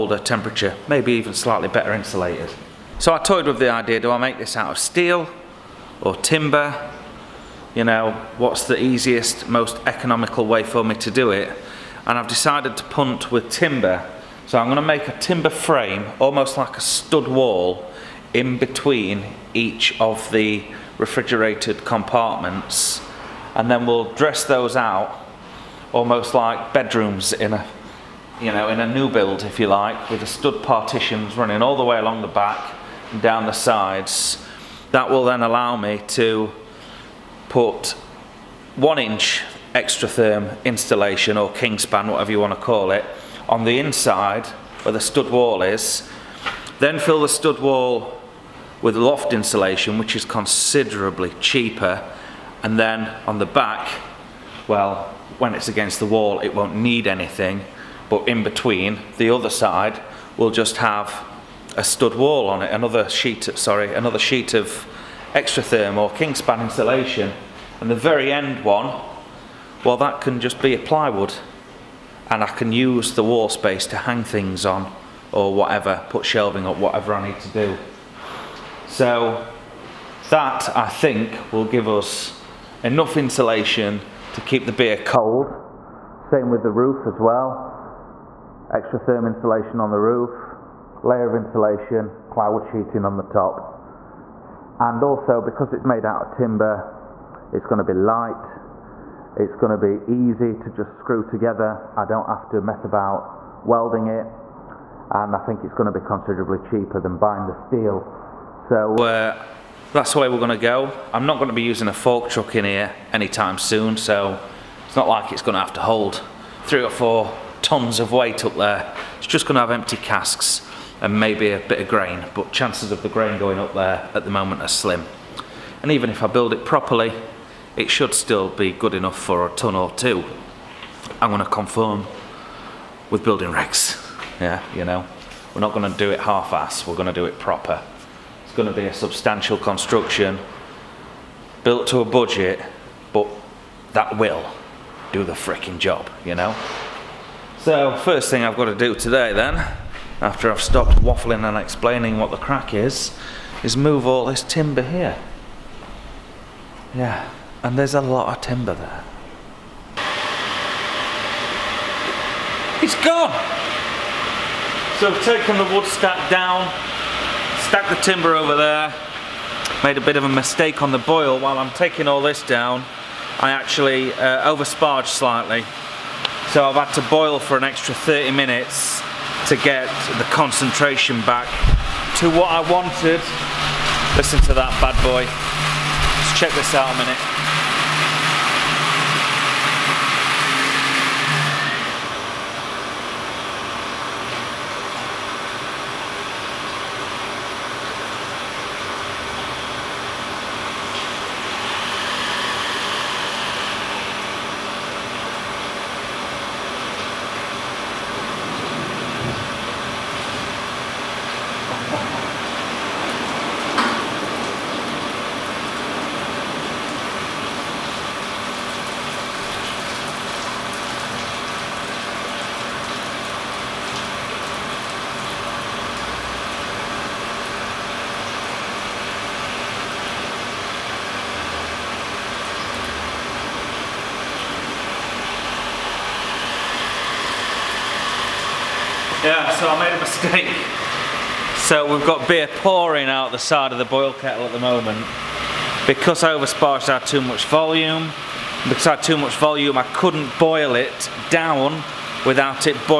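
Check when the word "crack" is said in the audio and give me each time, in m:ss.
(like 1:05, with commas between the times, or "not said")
2:32.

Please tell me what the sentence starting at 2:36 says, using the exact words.
Yeah, and there's a lot of timber there.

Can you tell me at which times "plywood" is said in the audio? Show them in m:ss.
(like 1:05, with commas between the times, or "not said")
1:10, 1:32.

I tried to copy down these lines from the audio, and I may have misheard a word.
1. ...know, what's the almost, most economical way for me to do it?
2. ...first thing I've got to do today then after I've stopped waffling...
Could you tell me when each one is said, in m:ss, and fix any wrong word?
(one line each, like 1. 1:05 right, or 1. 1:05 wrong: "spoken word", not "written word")
1. 0:07 wrong: "easiest", not "almost"
2. 2:27 right.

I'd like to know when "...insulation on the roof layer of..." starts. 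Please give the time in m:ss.
1:29.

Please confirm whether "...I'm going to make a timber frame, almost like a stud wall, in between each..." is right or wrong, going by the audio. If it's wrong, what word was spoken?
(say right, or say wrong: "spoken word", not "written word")
right.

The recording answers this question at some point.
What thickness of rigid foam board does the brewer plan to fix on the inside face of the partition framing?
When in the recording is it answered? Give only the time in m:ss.
0:38.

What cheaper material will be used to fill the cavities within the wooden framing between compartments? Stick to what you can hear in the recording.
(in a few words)
Loft insulation.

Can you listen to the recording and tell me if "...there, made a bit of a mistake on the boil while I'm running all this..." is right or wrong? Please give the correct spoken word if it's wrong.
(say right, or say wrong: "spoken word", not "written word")
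wrong: "taking", not "running".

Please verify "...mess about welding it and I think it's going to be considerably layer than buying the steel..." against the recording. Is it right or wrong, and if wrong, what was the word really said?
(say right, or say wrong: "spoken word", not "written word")
wrong: "cheaper", not "layer".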